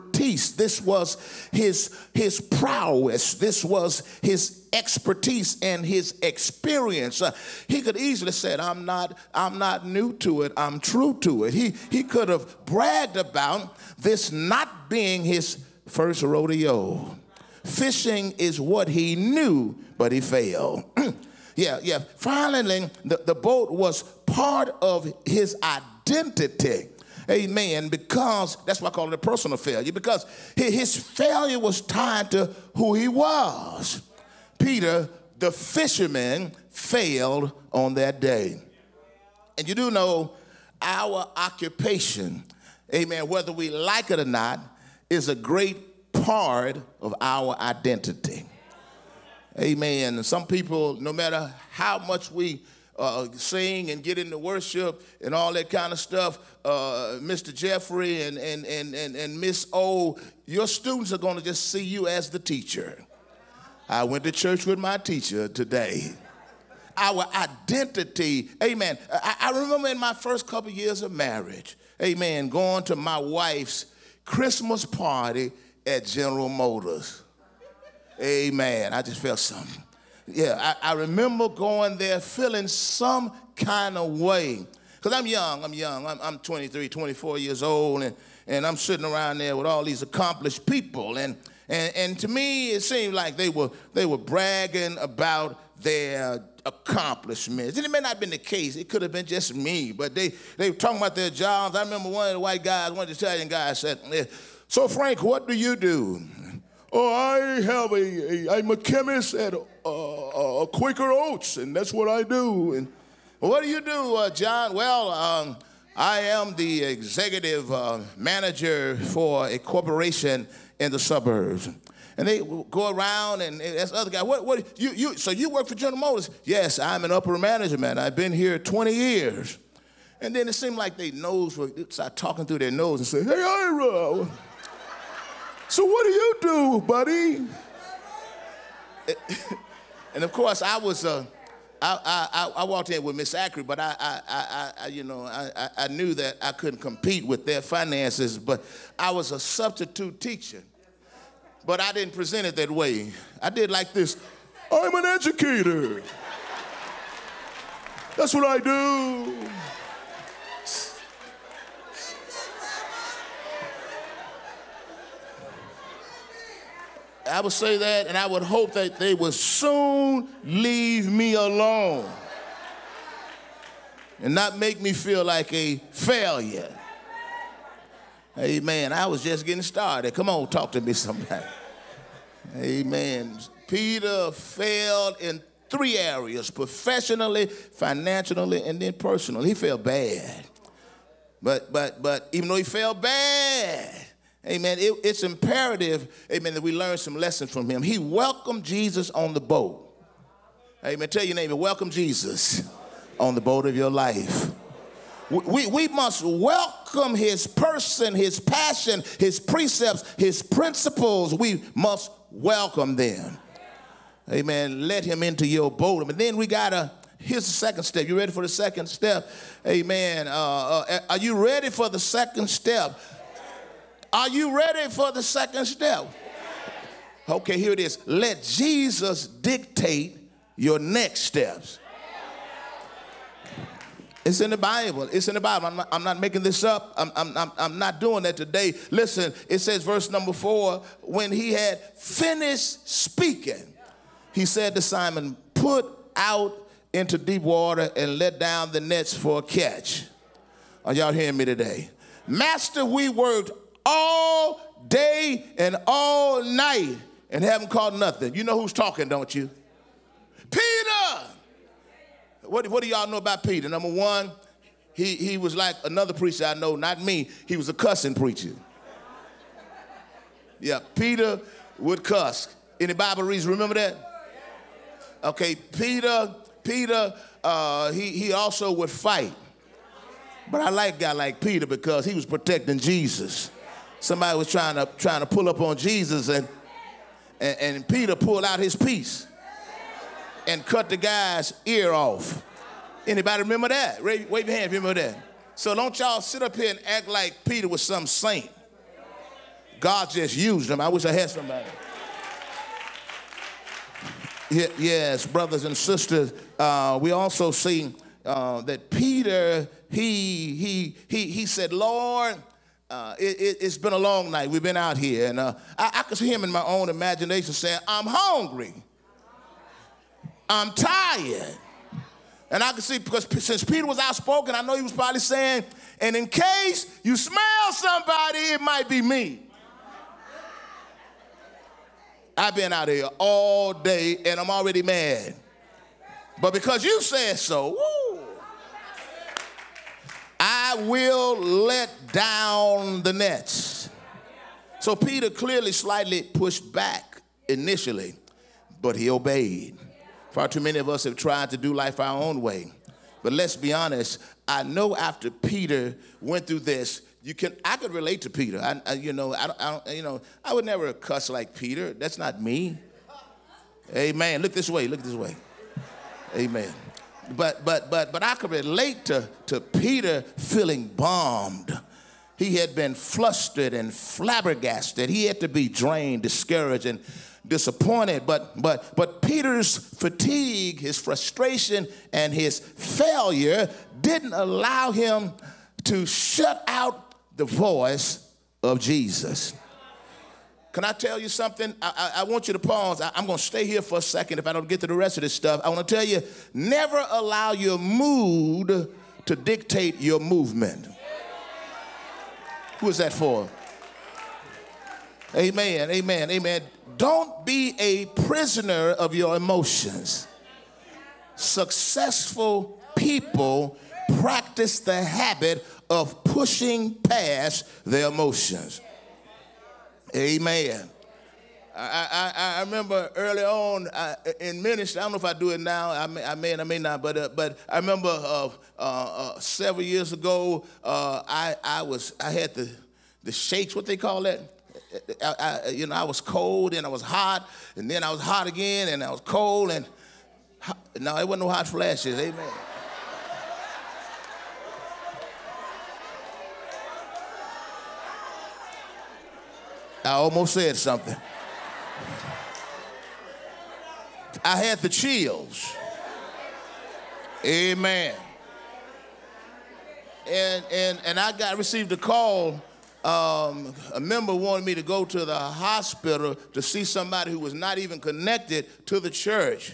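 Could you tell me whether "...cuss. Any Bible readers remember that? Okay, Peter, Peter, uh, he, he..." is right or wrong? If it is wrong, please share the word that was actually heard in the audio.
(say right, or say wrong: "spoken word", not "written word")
right.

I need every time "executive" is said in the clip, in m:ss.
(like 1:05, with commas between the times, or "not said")
1:56.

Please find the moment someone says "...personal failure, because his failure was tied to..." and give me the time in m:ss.
0:29.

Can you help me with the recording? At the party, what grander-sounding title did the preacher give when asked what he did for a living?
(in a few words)
educator.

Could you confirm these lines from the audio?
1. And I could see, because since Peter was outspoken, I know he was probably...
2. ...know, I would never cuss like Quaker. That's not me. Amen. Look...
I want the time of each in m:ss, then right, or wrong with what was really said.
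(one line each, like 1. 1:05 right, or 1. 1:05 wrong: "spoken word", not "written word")
1. 5:22 right
2. 6:00 wrong: "Peter", not "Quaker".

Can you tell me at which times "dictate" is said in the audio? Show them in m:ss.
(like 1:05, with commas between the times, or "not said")
3:49, 6:39.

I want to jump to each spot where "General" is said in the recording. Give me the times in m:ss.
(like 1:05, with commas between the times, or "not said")
1:16, 2:05.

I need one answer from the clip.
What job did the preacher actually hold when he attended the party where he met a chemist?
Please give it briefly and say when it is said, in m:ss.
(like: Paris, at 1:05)
substitute teacher, at 2:29.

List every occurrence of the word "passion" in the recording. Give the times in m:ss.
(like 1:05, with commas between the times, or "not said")
3:28.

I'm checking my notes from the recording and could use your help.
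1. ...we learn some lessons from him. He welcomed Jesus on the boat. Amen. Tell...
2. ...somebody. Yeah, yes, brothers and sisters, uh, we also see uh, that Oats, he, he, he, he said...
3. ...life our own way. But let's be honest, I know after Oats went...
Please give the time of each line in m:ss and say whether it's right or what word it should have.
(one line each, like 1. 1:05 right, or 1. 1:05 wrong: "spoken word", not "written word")
1. 3:16 right
2. 5:01 wrong: "Peter", not "Oats"
3. 5:51 wrong: "Peter", not "Oats".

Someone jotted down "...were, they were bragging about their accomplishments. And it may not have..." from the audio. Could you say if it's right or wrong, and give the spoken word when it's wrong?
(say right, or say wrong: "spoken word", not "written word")
right.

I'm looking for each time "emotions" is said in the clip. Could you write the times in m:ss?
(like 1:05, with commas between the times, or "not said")
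6:49, 6:58.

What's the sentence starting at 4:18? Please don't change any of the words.
You know who's talking, don't you?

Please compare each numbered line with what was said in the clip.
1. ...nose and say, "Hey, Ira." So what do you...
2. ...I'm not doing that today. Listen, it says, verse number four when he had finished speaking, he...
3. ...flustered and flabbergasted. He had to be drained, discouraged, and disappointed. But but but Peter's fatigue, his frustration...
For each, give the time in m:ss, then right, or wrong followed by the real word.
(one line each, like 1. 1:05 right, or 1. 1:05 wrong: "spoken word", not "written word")
1. 2:12 right
2. 3:57 right
3. 6:12 right.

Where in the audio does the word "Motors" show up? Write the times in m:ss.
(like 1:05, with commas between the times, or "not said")
1:16, 2:05.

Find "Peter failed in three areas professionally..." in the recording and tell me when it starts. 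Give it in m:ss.
3:03.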